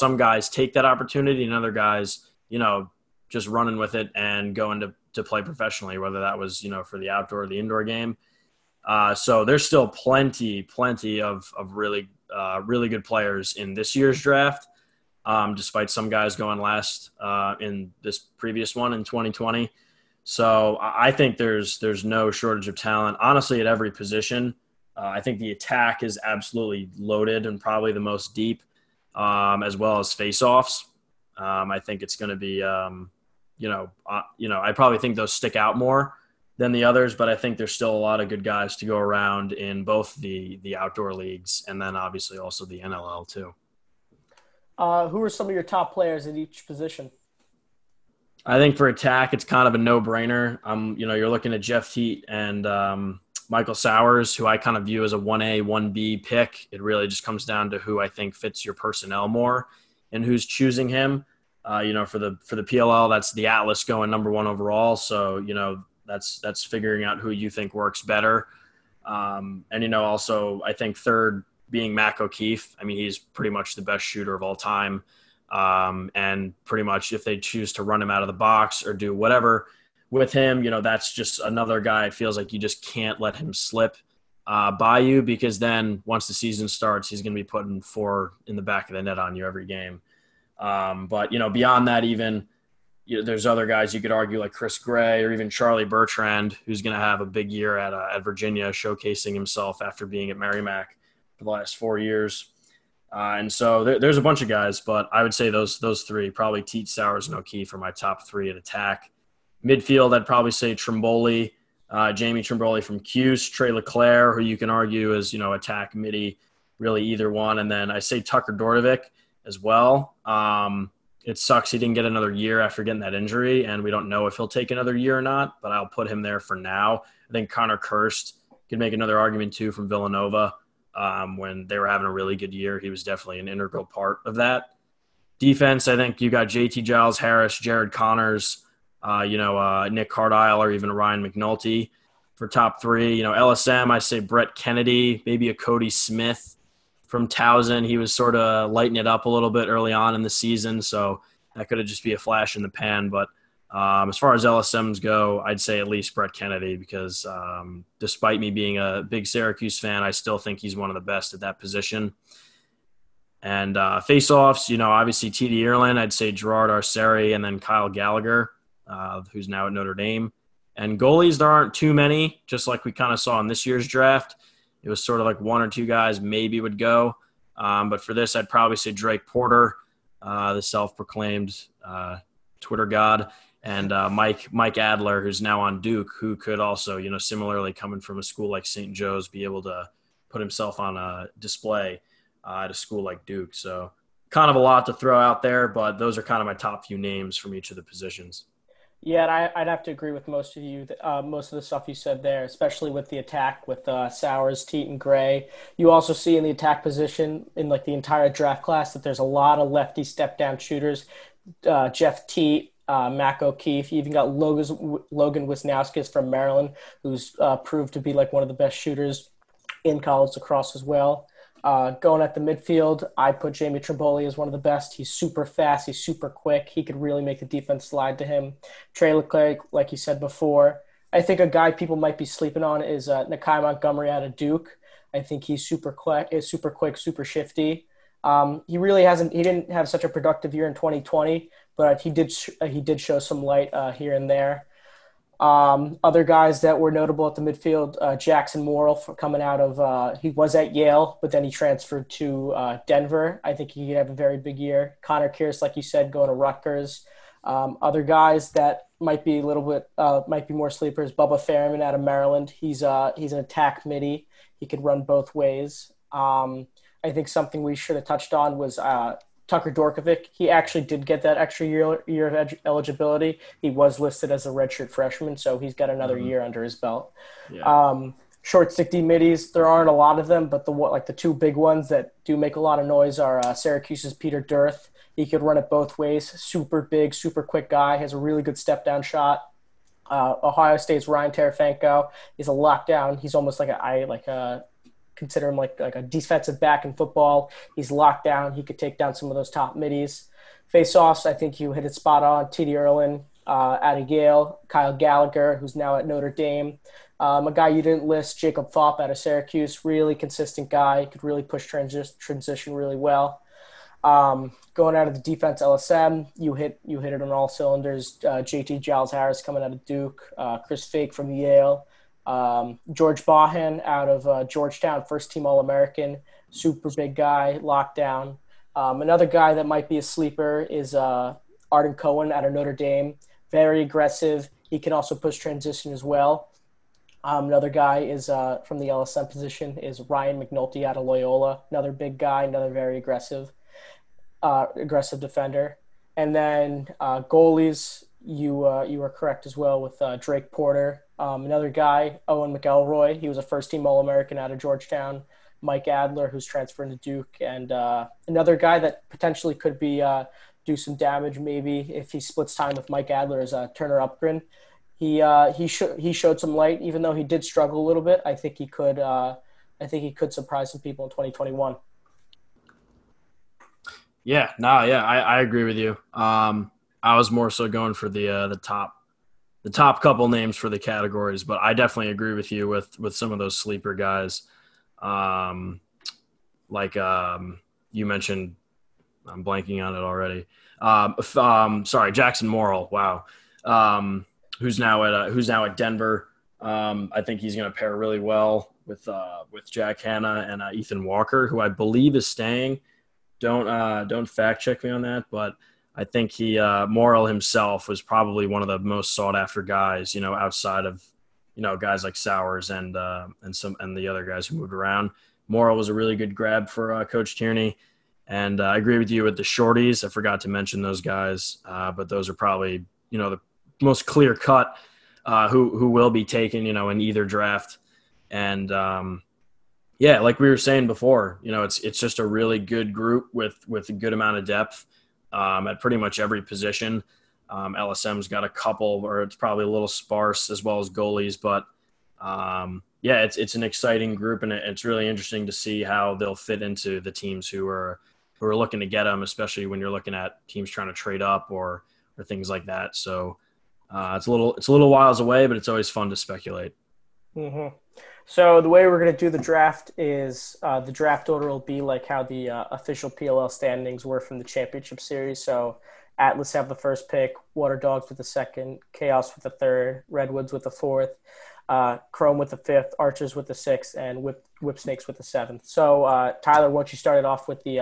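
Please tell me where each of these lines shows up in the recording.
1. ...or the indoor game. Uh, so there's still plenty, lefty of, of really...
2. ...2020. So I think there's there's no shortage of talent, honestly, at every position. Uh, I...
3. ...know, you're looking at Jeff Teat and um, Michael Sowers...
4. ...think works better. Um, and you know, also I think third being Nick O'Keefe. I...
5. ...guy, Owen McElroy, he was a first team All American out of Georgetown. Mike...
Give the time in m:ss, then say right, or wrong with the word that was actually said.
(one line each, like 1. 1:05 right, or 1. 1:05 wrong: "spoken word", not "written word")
1. 0:07 wrong: "plenty", not "lefty"
2. 0:19 right
3. 0:51 right
4. 1:07 wrong: "Mac", not "Nick"
5. 5:51 right.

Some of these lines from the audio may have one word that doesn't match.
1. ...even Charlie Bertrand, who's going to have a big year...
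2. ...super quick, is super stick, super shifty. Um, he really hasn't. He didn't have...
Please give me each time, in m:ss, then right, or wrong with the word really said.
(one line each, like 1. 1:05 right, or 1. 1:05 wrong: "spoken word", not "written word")
1. 1:35 right
2. 3:55 wrong: "quick", not "stick".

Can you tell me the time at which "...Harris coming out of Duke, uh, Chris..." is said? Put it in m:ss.
5:19.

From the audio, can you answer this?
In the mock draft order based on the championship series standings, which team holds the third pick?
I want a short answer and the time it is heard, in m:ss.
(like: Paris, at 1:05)
Chaos, at 7:48.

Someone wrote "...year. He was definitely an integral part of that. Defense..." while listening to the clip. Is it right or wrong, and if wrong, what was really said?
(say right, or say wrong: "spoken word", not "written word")
right.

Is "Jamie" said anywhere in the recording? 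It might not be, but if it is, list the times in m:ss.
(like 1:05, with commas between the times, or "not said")
1:52, 3:43.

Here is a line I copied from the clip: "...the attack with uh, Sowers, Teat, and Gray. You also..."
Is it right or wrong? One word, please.
right.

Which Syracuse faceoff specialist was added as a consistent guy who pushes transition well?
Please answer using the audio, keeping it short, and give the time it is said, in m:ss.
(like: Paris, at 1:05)
Jakob Phaup, at 5:08.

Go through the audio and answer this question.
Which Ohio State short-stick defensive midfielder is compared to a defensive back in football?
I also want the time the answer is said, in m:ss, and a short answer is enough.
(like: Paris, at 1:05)
Ryan Terefenko, at 4:51.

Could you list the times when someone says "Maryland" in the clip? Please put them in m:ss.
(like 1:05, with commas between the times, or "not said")
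3:36, 4:22.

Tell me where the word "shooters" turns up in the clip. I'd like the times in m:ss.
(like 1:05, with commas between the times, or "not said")
1:14, 3:30, 3:38.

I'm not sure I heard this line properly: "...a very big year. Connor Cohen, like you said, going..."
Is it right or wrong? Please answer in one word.
wrong.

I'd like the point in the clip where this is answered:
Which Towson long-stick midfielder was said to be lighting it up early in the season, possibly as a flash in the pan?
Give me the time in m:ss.
2:25.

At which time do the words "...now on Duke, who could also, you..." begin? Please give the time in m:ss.
3:05.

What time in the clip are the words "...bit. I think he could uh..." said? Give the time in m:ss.
6:08.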